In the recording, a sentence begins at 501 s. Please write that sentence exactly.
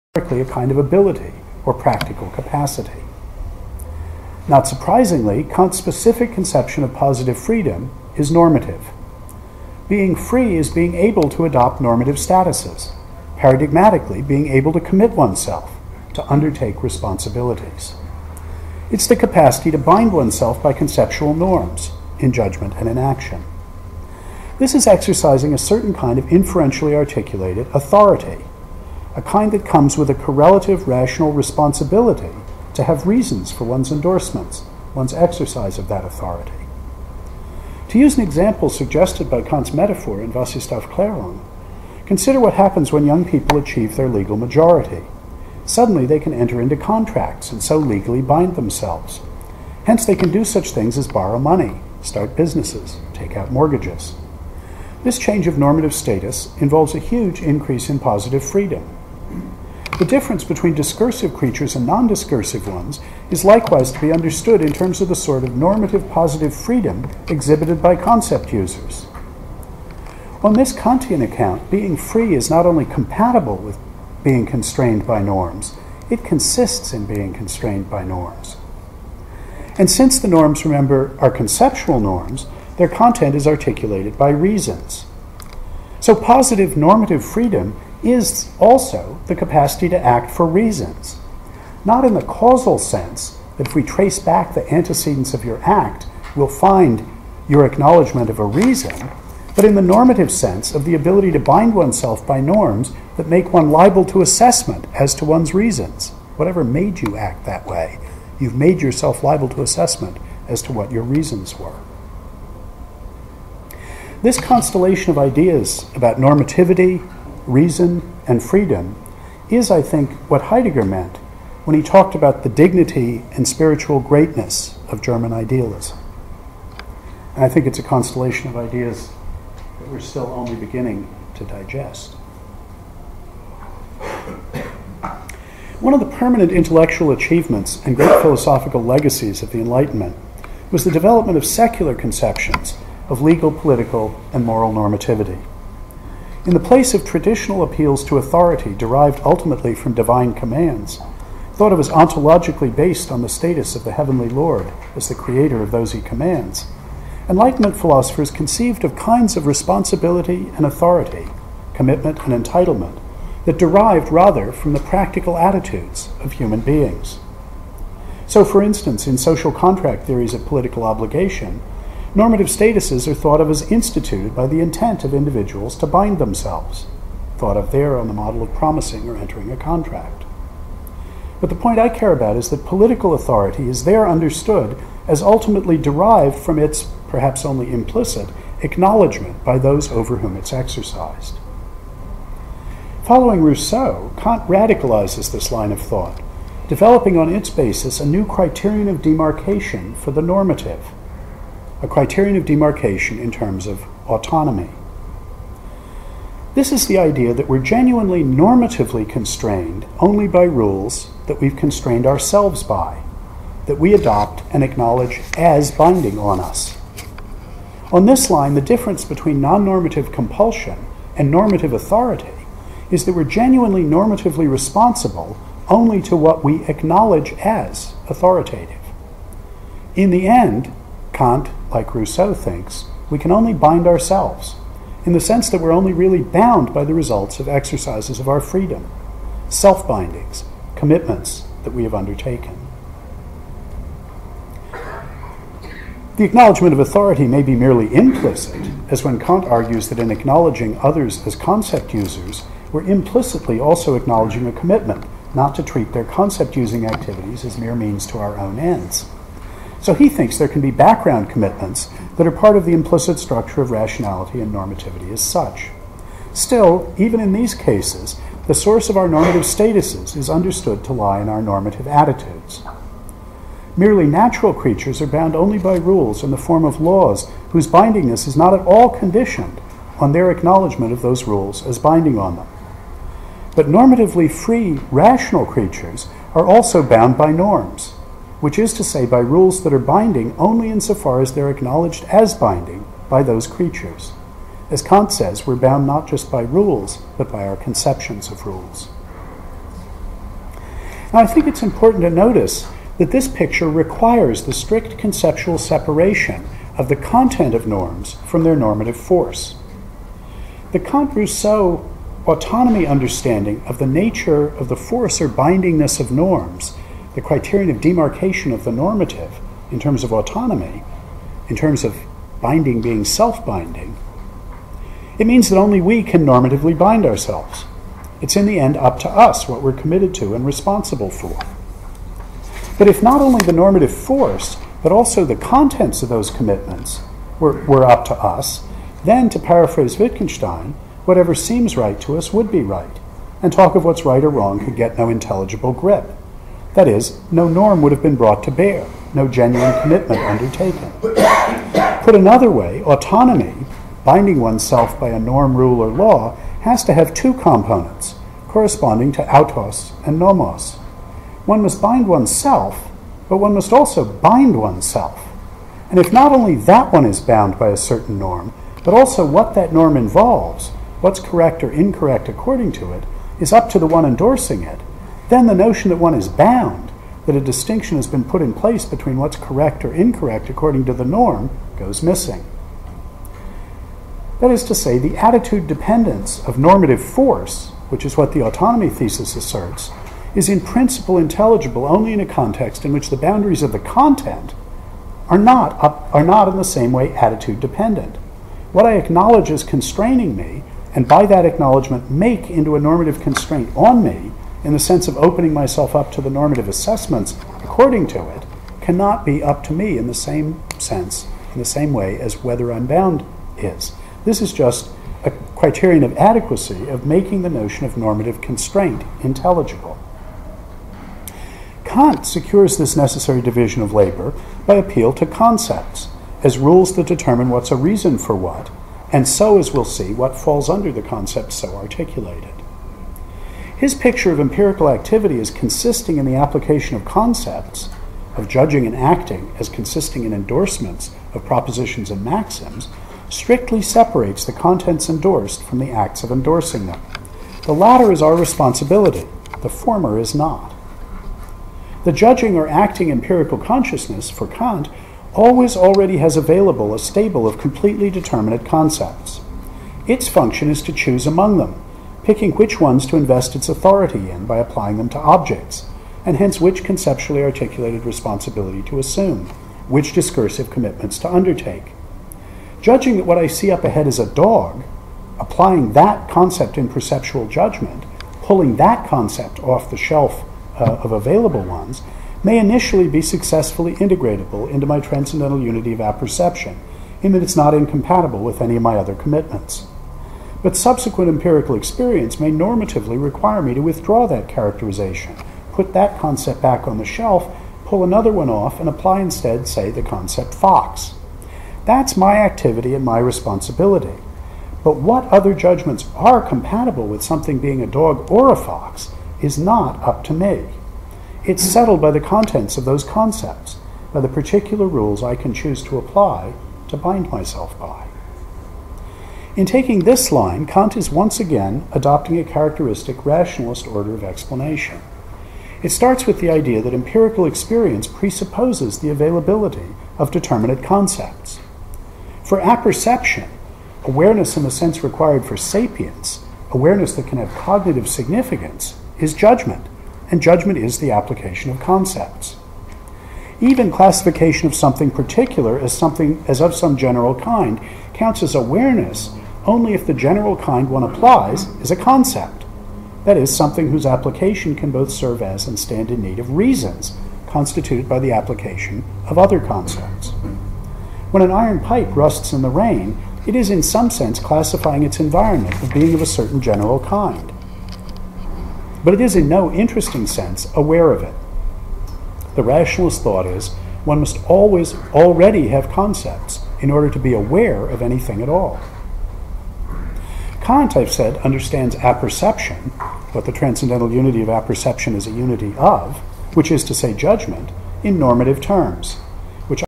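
That's my activity and my responsibility.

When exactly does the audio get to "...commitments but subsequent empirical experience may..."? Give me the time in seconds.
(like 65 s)
489 s.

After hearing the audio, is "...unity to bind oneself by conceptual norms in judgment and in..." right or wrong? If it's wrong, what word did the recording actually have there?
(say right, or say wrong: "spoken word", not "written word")
wrong: "capacity", not "unity".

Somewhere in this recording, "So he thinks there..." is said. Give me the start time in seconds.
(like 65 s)
259 s.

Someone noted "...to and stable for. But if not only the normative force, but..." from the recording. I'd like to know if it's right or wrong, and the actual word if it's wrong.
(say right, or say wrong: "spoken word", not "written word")
wrong: "responsible", not "stable".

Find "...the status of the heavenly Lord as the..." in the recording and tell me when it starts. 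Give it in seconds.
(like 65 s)
153 s.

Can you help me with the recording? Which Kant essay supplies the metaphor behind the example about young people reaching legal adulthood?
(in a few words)
Was ist Aufklärung.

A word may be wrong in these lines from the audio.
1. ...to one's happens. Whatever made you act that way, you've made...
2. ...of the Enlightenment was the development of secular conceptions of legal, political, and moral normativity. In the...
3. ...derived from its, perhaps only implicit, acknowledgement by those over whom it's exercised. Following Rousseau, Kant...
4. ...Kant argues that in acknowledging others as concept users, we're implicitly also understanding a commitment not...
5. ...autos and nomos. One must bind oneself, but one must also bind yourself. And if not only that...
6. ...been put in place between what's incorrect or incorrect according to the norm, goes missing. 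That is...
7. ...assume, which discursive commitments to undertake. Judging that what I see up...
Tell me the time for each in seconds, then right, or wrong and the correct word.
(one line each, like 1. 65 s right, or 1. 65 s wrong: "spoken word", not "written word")
1. 105 s wrong: "reasons", not "happens"
2. 139 s right
3. 185 s right
4. 249 s wrong: "acknowledging", not "understanding"
5. 359 s wrong: "oneself", not "yourself"
6. 378 s wrong: "correct", not "incorrect"
7. 468 s right.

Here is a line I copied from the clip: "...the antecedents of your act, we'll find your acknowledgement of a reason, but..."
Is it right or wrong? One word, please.
right.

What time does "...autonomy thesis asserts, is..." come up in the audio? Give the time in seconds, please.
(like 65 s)
388 s.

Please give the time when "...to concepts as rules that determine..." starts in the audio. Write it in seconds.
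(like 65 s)
425 s.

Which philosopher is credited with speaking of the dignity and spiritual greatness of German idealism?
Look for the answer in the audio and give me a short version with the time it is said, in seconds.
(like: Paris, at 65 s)
Heidegger, at 120 s.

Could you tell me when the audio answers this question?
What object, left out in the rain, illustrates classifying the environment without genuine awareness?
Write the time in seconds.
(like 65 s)
561 s.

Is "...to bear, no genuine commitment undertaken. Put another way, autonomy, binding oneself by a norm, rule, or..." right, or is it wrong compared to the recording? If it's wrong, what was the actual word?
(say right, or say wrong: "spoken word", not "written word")
right.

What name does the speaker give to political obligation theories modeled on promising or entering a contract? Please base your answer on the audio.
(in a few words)
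social contract theories.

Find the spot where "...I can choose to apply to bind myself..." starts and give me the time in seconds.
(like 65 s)
515 s.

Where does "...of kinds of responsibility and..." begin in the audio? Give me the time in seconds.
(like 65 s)
158 s.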